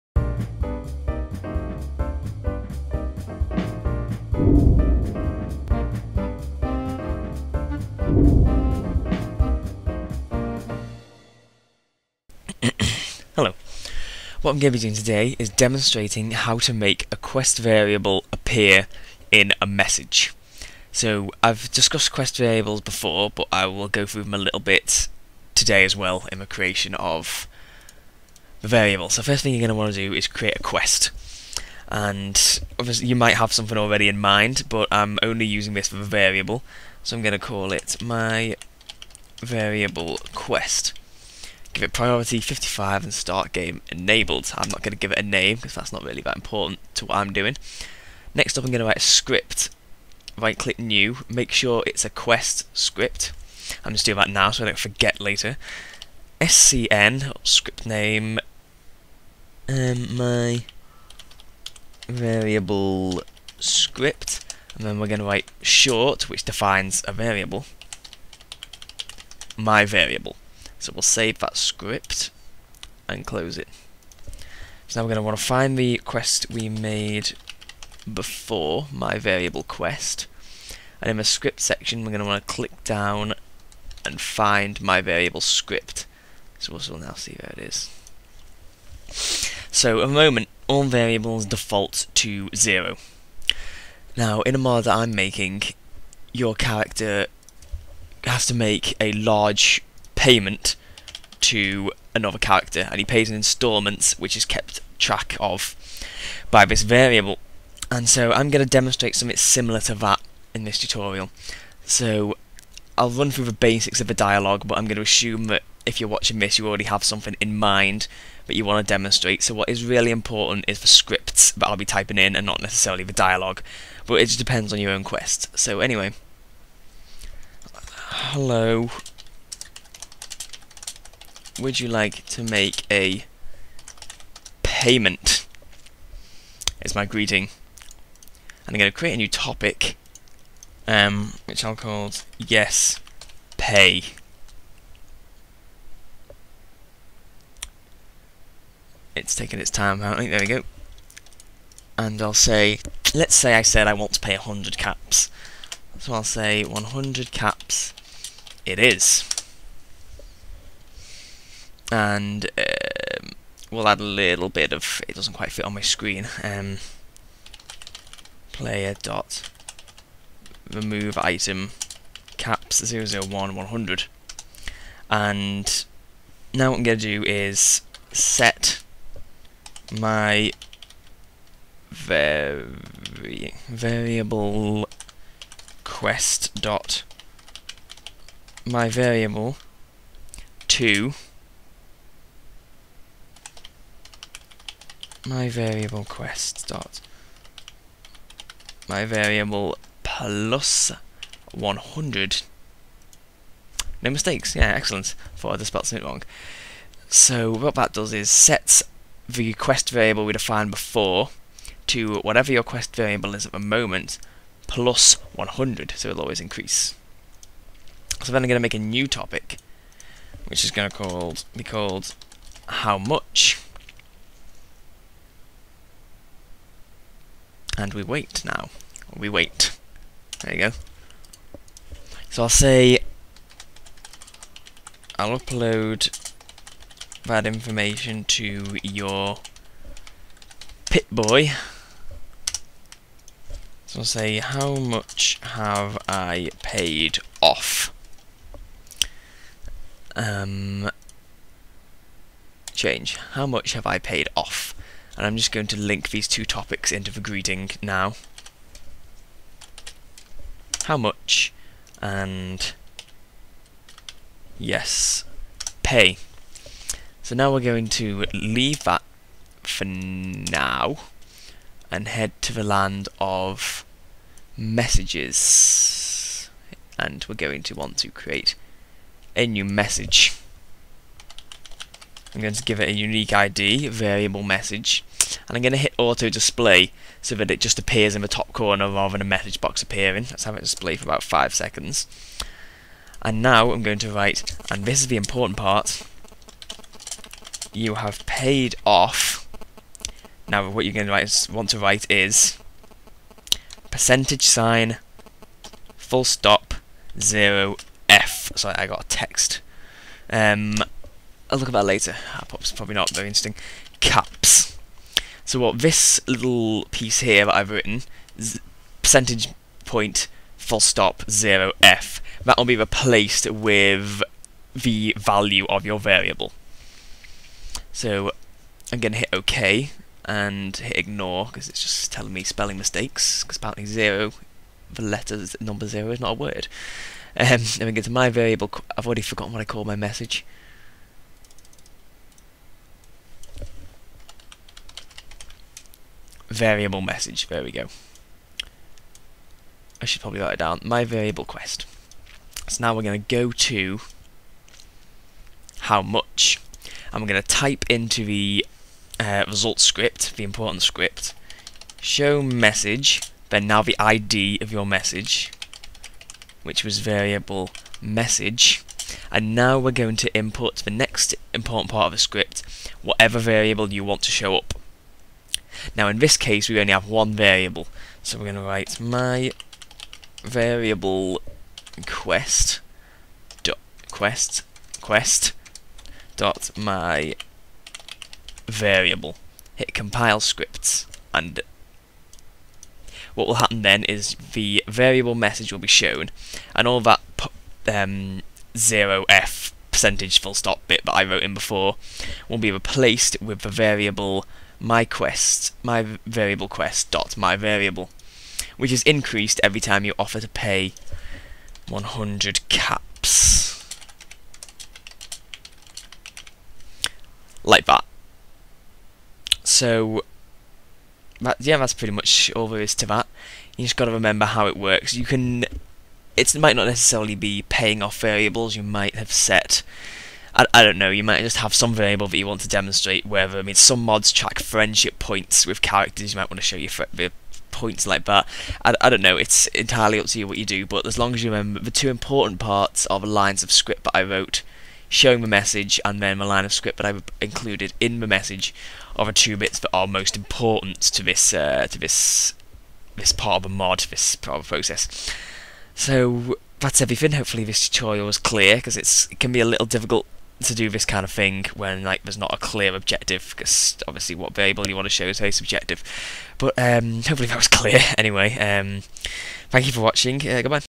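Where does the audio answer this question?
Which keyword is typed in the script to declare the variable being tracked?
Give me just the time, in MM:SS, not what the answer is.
01:05.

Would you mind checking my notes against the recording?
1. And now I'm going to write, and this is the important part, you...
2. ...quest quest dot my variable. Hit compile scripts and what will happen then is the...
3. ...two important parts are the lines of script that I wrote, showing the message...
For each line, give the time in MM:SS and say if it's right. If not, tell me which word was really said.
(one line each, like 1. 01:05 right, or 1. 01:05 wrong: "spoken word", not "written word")
1. 04:53 right
2. 06:24 right
3. 07:21 right.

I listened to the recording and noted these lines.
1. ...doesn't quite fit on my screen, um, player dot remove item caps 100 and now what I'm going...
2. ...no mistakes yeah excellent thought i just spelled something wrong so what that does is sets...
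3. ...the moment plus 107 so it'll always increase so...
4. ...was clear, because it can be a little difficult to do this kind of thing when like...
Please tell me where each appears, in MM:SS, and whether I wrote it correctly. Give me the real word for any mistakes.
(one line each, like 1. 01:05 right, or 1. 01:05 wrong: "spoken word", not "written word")
1. 02:45 right
2. 03:24 right
3. 03:33 wrong: "100", not "107"
4. 07:38 right.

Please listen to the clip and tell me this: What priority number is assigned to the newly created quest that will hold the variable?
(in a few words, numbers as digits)
55.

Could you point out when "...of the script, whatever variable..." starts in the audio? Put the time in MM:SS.
06:12.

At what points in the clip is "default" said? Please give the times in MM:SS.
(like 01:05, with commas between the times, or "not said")
01:31.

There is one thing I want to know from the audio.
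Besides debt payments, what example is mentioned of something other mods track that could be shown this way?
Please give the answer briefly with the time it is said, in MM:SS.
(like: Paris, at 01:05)
friendship points, at 07:14.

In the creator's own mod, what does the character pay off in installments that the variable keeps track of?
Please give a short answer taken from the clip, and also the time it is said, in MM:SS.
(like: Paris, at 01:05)
a large payment, at 01:38.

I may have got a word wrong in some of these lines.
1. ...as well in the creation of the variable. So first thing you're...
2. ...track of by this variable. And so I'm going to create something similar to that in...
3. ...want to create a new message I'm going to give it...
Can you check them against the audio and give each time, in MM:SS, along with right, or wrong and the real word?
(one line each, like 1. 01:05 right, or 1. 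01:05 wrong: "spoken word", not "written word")
1. 00:25 right
2. 01:44 wrong: "demonstrate", not "create"
3. 04:37 right.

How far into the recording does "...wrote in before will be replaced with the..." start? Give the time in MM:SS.
06:41.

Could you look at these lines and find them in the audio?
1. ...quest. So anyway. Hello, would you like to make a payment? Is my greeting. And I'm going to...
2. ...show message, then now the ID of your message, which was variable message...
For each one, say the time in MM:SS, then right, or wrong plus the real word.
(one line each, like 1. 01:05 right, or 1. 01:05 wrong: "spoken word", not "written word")
1. 02:05 right
2. 06:01 right.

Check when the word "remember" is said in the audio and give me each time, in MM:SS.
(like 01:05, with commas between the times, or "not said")
07:04, 07:21.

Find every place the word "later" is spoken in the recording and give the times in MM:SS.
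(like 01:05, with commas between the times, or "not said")
00:55, 05:11.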